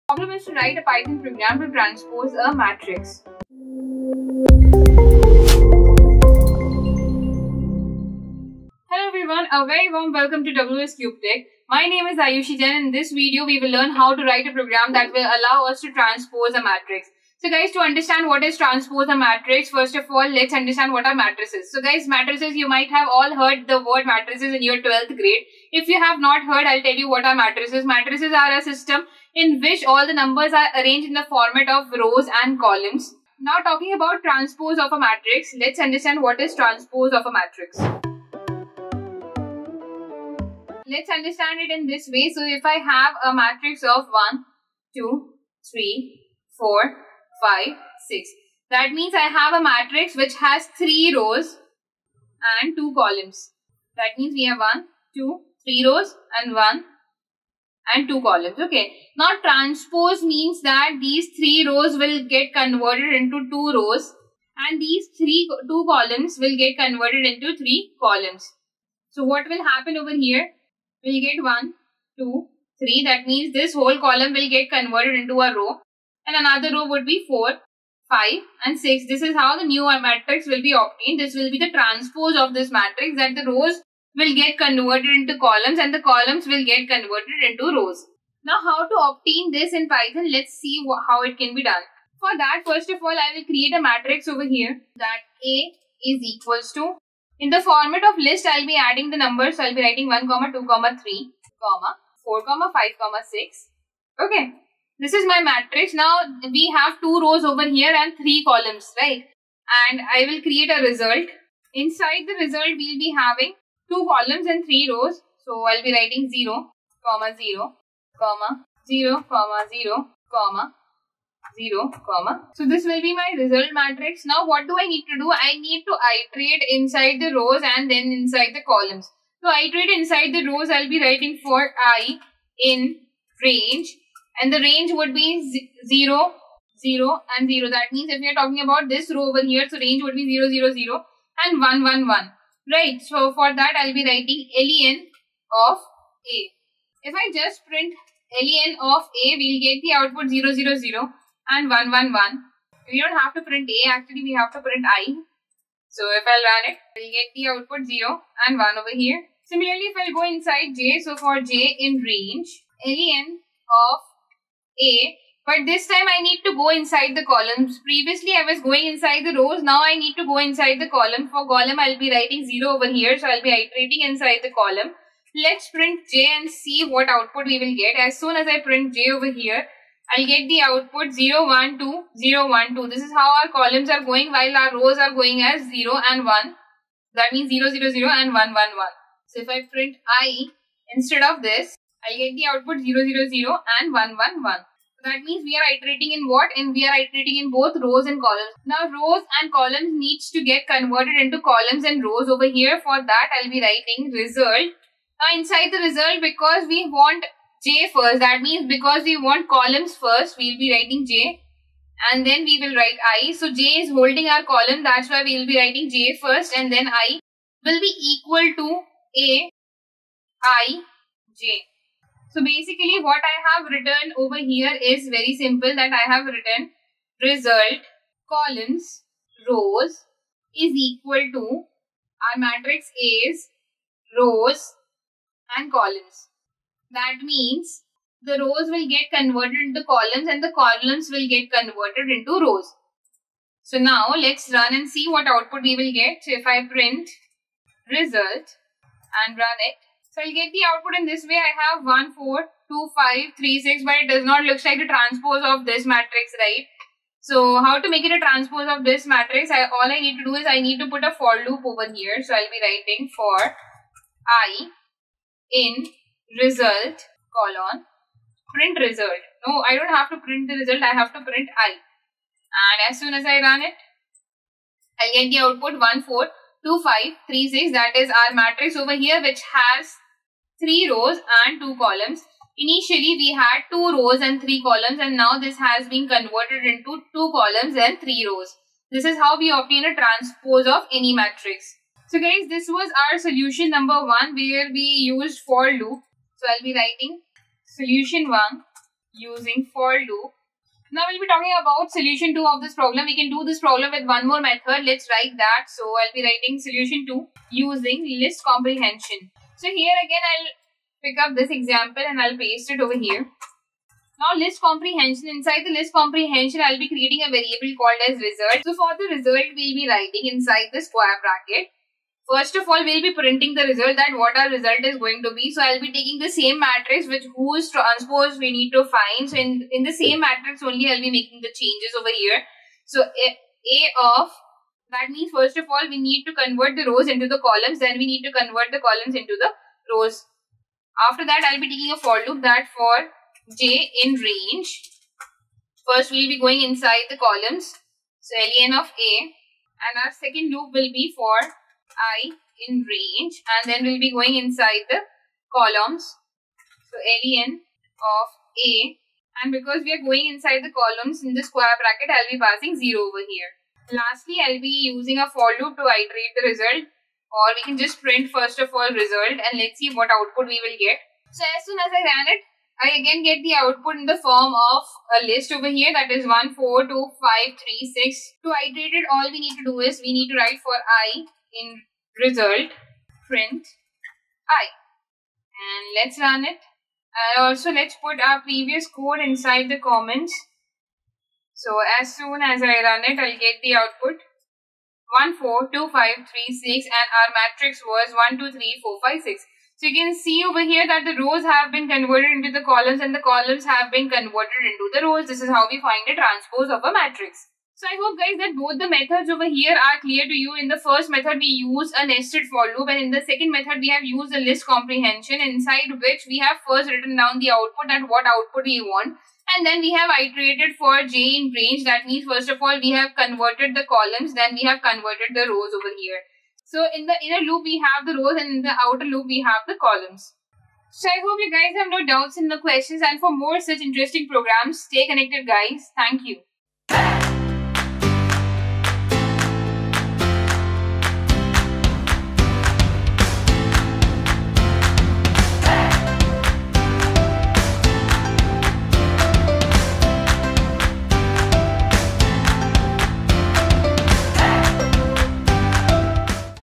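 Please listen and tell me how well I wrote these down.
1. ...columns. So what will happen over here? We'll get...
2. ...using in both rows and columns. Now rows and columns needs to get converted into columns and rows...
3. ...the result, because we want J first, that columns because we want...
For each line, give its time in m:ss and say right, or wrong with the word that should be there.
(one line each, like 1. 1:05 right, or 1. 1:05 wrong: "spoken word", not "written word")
1. 1:07 right
2. 3:16 wrong: "iterating", not "using"
3. 3:25 wrong: "means", not "columns".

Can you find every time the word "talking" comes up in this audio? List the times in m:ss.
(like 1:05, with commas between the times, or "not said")
0:33, 2:18, 5:01.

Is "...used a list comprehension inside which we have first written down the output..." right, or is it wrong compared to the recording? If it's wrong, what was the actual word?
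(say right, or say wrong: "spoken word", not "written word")
right.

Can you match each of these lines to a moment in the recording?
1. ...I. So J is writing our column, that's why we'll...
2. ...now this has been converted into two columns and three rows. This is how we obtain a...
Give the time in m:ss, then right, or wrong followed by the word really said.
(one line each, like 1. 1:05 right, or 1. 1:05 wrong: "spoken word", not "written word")
1. 3:33 wrong: "holding", not "writing"
2. 4:45 right.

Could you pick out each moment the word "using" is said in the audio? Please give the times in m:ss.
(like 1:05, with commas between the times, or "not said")
4:59, 5:07, 6:04.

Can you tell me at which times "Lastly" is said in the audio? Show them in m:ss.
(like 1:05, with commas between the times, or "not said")
6:03.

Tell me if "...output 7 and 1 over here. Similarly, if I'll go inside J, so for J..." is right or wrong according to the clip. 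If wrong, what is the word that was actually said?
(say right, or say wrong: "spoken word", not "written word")
wrong: "0", not "7".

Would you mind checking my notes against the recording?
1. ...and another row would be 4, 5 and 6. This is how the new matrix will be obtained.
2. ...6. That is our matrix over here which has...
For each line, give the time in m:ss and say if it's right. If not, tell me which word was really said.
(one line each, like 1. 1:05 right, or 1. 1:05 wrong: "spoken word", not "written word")
1. 1:16 right
2. 4:37 right.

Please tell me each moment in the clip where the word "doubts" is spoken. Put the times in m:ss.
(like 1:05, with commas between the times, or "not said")
7:12.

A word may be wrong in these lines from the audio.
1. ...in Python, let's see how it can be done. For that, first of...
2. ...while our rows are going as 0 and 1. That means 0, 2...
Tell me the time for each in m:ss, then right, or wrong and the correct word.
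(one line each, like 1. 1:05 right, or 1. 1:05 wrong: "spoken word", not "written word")
1. 1:29 right
2. 3:04 wrong: "0", not "2".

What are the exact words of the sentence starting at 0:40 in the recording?
Let's understand it in this way.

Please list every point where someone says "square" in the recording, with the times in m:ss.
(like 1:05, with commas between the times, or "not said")
5:20, 6:01.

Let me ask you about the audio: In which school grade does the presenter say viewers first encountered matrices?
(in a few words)
12th grade.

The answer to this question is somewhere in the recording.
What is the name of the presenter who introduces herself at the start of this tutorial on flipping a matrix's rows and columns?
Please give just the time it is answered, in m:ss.
0:12.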